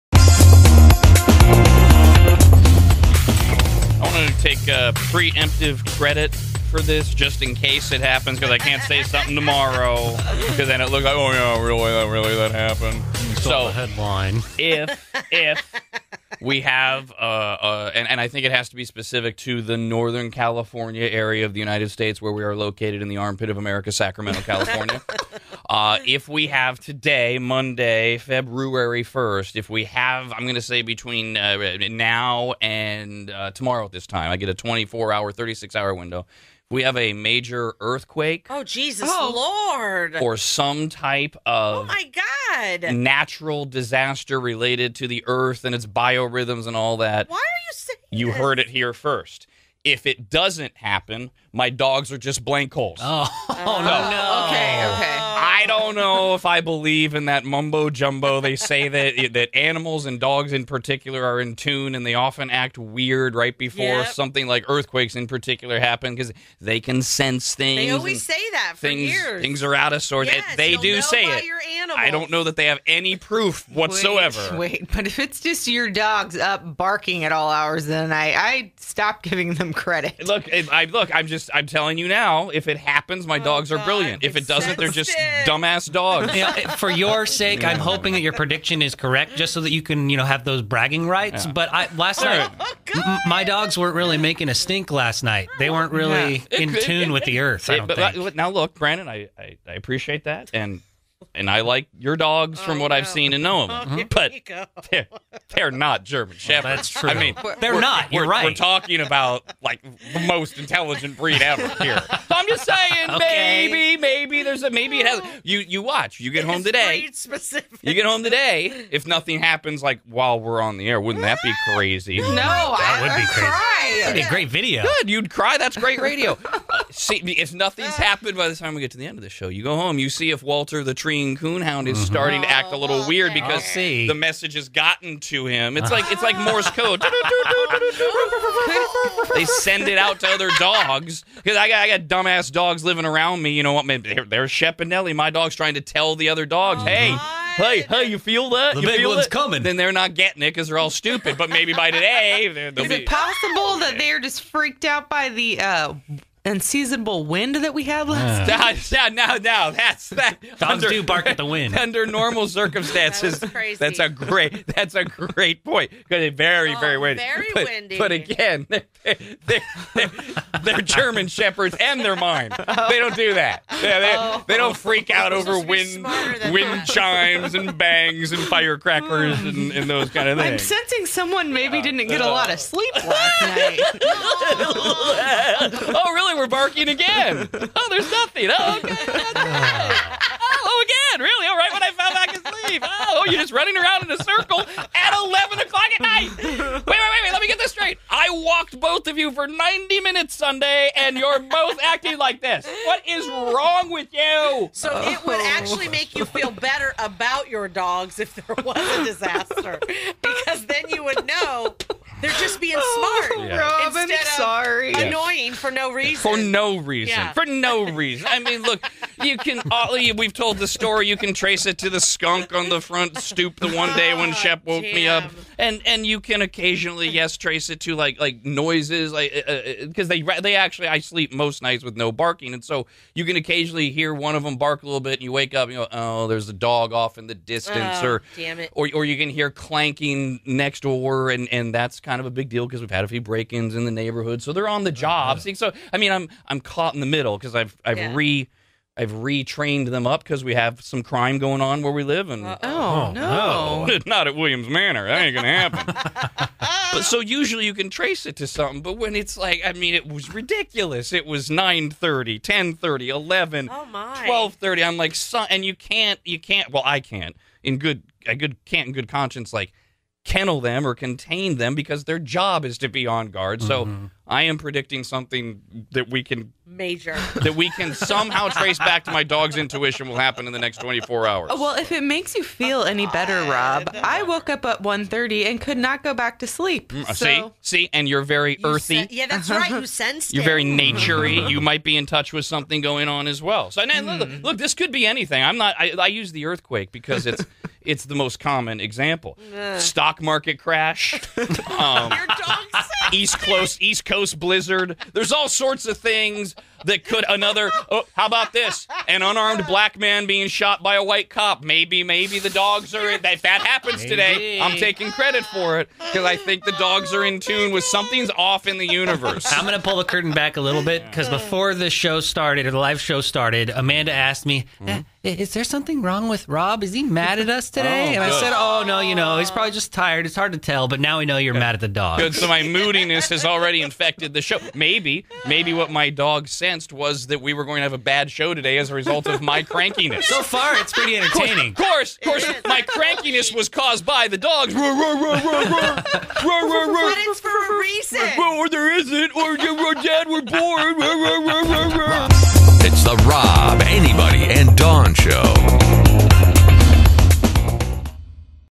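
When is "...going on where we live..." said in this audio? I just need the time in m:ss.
4:11.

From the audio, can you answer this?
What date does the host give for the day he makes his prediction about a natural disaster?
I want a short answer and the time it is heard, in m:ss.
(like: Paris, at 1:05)
Monday, February 1st, at 0:27.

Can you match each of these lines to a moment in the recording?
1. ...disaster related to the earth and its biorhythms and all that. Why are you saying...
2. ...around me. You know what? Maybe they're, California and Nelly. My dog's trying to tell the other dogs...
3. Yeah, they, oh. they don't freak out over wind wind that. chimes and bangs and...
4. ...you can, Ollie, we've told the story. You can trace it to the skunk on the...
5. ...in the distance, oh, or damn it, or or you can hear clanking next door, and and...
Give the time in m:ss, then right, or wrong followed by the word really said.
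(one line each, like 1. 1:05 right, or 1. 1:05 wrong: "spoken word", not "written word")
1. 0:43 right
2. 2:23 wrong: "Shep", not "California"
3. 2:53 right
4. 3:39 right
5. 3:57 right.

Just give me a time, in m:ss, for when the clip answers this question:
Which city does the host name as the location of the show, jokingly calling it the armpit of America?
0:23.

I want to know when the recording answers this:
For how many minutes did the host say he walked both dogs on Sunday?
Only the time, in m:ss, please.
3:19.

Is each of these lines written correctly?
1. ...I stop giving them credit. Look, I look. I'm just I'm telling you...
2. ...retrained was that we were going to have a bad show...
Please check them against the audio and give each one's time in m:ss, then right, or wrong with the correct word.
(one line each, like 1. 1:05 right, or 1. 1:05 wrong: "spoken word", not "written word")
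1. 1:18 right
2. 5:36 wrong: "convinced", not "retrained".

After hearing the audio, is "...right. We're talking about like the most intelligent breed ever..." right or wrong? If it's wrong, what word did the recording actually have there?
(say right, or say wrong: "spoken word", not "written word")
right.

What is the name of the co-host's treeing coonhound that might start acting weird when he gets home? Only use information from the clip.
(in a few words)
Walter.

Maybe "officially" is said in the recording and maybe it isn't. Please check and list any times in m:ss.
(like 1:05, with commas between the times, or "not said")
not said.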